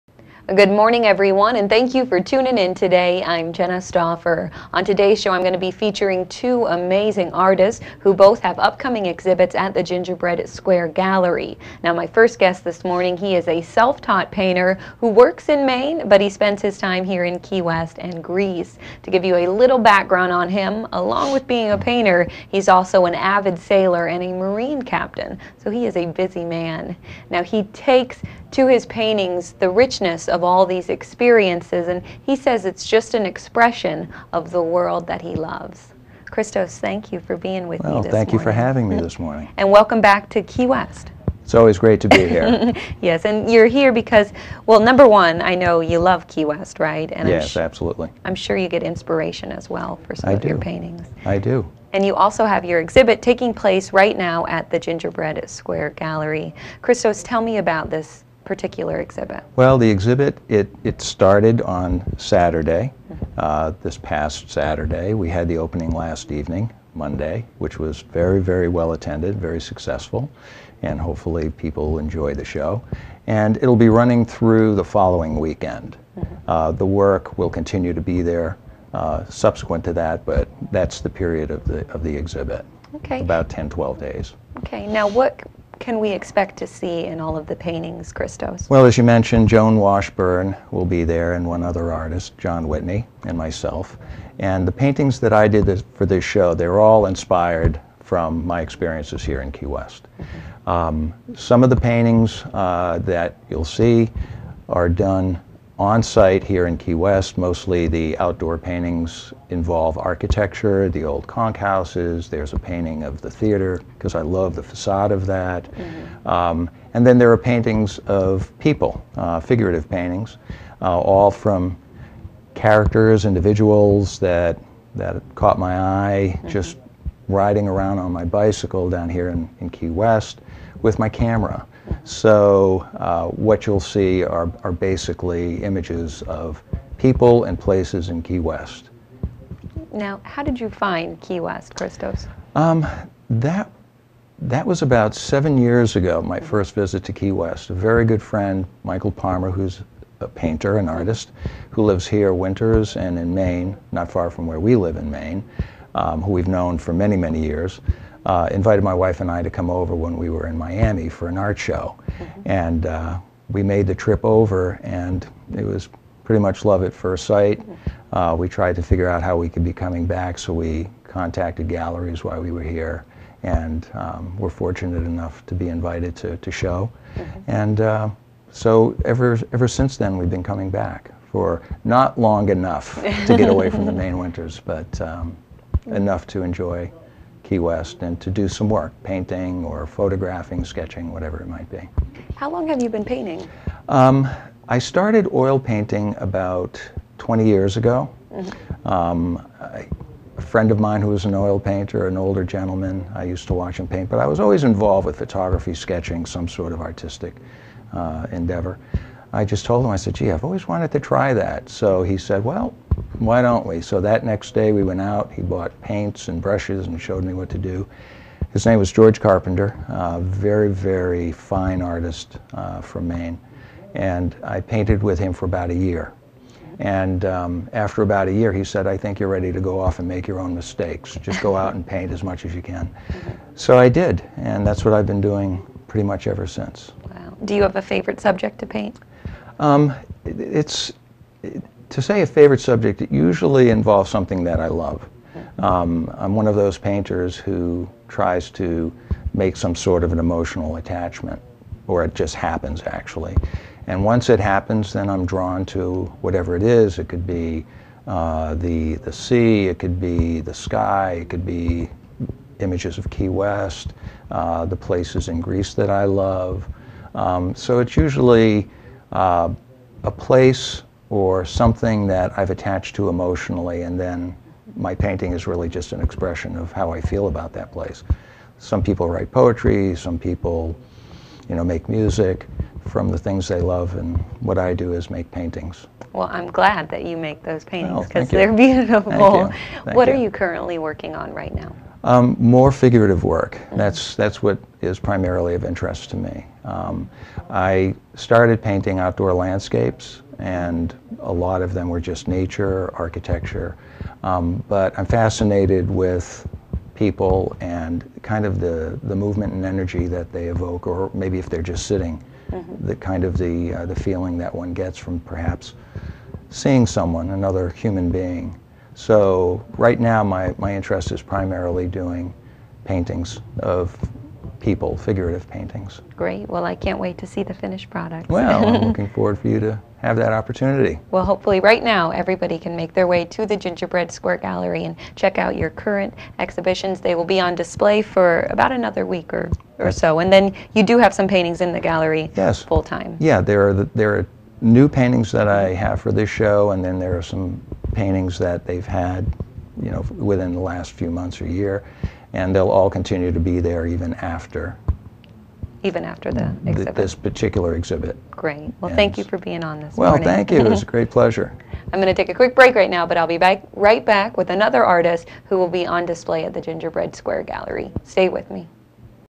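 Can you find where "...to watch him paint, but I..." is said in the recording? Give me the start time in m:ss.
3:23.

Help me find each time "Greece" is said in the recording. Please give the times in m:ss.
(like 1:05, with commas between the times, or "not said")
0:18, 4:25.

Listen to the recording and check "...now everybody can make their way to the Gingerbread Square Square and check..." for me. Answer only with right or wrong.
wrong.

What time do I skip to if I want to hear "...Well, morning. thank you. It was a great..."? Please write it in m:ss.
5:59.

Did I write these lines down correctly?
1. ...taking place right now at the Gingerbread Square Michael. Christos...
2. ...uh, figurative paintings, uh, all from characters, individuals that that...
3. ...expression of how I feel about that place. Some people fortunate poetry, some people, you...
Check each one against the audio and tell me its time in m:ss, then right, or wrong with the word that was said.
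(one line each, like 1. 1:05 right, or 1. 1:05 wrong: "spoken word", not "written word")
1. 0:53 wrong: "Gallery", not "Michael"
2. 1:59 right
3. 4:36 wrong: "write", not "fortunate".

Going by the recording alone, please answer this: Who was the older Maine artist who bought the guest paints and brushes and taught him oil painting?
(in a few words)
George Carpenter.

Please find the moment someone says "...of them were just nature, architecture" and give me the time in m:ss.
5:01.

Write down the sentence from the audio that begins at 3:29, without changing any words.
I just told him, I said, gee, I've always wanted to try that.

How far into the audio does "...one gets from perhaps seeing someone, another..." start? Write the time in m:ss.
5:14.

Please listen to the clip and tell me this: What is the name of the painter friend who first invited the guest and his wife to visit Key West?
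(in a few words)
Michael Palmer.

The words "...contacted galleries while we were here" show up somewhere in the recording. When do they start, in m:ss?
2:51.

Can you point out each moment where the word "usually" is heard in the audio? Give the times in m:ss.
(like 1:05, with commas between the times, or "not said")
4:03, 4:27.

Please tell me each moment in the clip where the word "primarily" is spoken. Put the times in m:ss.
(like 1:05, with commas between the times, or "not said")
4:55, 5:21.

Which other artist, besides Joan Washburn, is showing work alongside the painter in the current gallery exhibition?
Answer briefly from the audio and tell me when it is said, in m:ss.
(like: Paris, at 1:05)
John Whitney, at 1:32.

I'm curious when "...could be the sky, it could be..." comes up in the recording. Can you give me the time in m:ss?
4:19.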